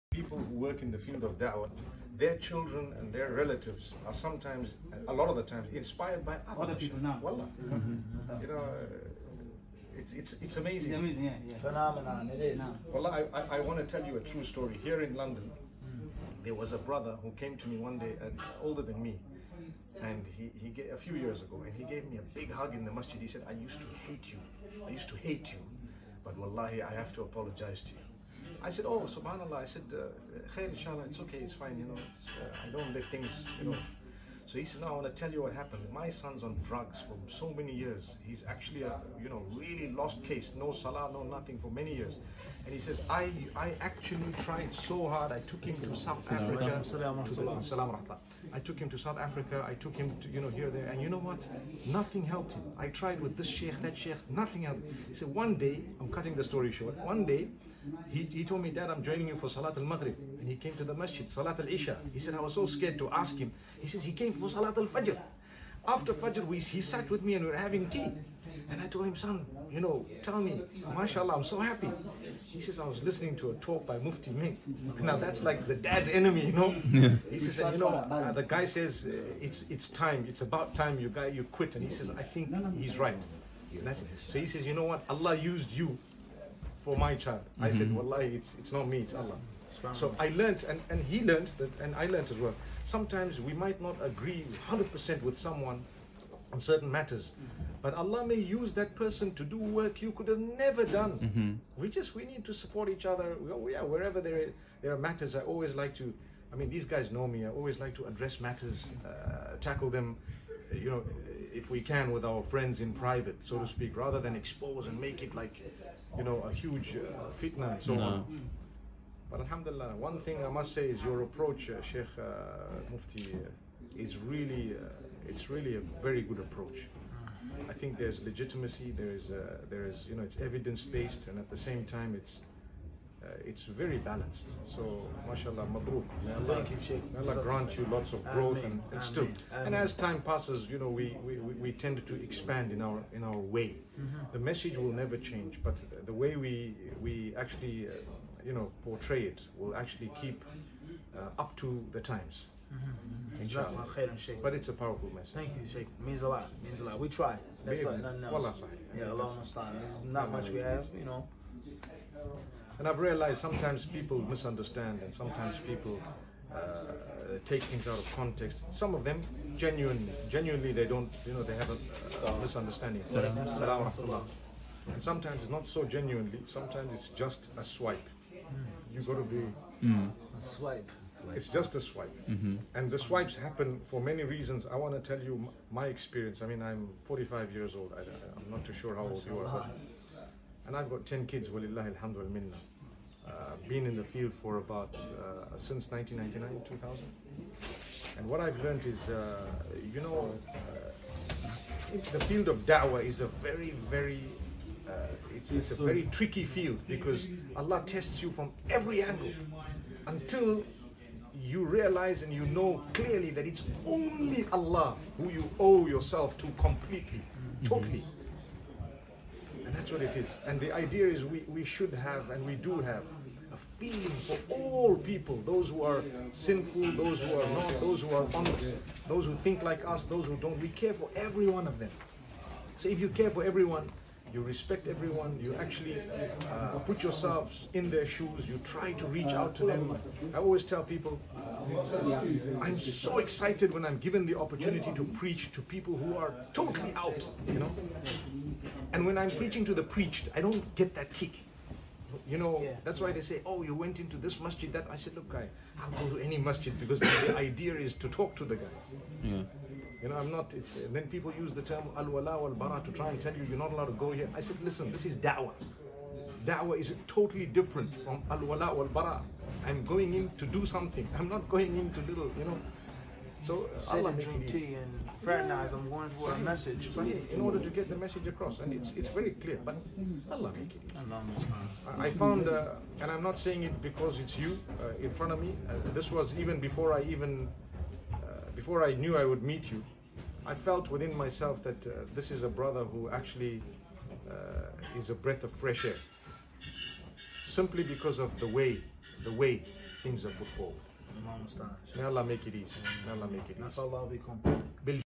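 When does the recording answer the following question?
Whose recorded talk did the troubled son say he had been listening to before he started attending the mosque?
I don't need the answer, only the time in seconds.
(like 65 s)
73 s.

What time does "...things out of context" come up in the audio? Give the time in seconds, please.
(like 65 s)
167 s.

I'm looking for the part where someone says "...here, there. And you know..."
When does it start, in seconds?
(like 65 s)
50 s.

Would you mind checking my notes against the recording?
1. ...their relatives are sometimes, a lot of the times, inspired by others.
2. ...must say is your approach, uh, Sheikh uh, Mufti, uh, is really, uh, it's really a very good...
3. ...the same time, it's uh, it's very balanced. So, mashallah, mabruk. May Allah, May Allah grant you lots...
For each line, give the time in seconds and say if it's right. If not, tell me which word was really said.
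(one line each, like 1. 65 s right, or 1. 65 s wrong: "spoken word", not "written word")
1. 3 s right
2. 120 s right
3. 131 s right.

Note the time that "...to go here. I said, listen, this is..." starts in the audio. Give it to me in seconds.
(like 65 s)
263 s.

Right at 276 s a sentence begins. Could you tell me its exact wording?
in order to get the message across, and it's it's very clear, but Allah make it easy.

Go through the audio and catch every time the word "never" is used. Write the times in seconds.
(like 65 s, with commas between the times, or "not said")
100 s, 144 s.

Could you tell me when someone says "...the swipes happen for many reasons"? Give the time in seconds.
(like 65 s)
182 s.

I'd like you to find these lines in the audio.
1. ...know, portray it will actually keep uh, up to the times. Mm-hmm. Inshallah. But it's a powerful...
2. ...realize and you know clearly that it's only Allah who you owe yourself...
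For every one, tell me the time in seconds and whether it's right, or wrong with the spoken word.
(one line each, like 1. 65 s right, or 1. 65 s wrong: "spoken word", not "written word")
1. 148 s right
2. 211 s right.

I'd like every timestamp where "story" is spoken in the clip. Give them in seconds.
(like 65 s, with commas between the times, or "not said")
14 s, 56 s.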